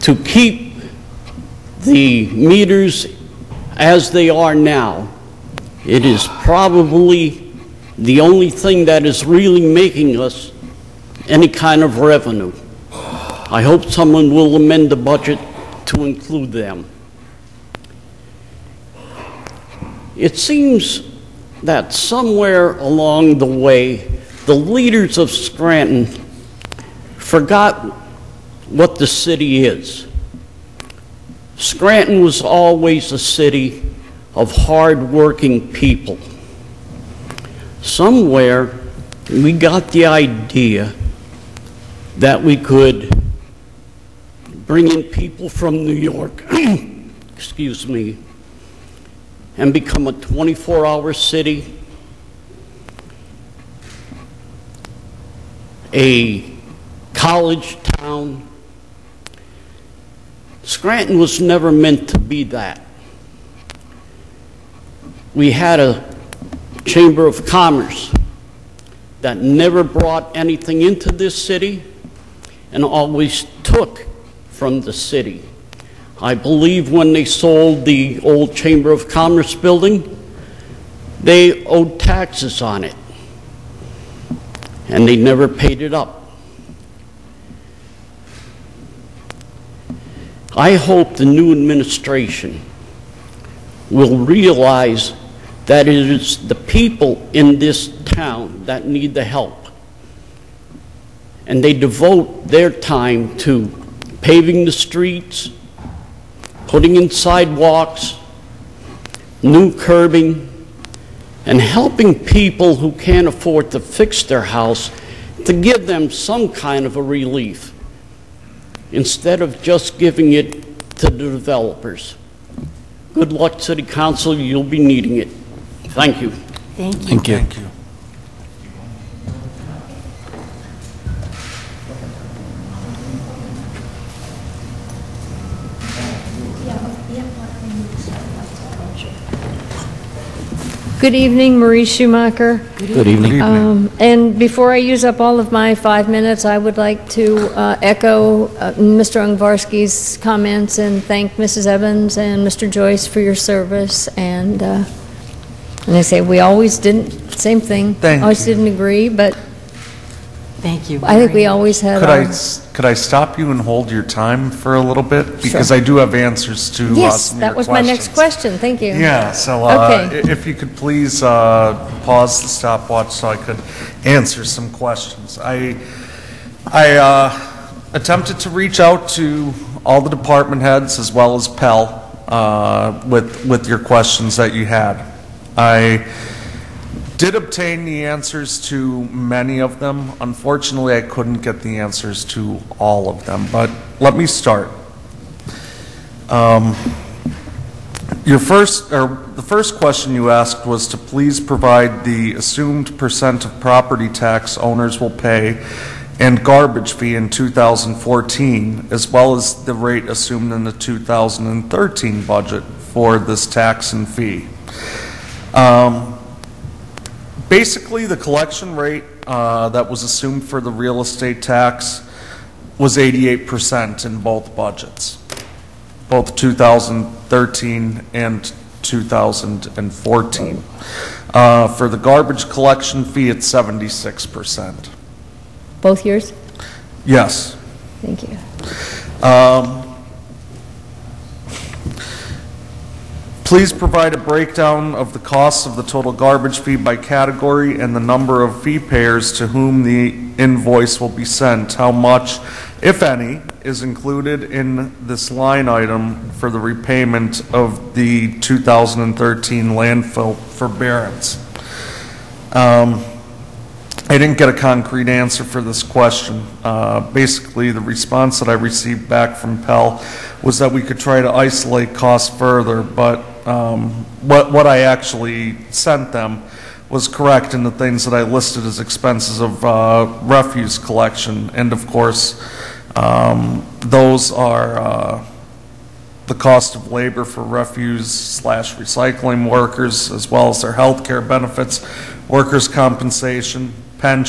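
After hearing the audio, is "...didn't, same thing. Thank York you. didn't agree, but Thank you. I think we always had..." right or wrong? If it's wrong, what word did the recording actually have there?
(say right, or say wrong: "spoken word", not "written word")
wrong: "Always", not "York".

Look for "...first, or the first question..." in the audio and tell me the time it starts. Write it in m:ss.
3:18.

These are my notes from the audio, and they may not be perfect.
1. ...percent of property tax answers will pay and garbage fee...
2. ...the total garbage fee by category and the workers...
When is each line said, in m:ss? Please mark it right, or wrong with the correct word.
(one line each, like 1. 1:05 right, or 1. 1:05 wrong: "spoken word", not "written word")
1. 3:22 wrong: "owners", not "answers"
2. 4:05 wrong: "number", not "workers".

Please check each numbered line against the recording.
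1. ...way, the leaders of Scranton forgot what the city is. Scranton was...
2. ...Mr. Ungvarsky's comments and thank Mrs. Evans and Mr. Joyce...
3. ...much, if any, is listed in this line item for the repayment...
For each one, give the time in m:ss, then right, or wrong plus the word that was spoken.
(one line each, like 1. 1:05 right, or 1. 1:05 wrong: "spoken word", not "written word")
1. 0:23 right
2. 2:28 right
3. 4:11 wrong: "included", not "listed".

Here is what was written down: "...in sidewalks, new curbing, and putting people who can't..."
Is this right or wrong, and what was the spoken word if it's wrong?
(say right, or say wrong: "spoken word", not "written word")
wrong: "helping", not "putting".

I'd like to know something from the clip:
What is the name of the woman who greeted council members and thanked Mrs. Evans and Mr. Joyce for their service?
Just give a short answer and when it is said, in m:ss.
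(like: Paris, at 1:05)
Marie Schumacher, at 2:21.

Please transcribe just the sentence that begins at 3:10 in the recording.
Unfortunately, I couldn't get the answers to all of them, but let me start.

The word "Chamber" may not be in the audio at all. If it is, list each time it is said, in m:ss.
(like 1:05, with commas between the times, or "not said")
1:06, 1:18.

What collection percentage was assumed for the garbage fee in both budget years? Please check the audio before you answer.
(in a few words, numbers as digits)
76%.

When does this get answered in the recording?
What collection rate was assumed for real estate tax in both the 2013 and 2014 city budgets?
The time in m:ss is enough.
3:42.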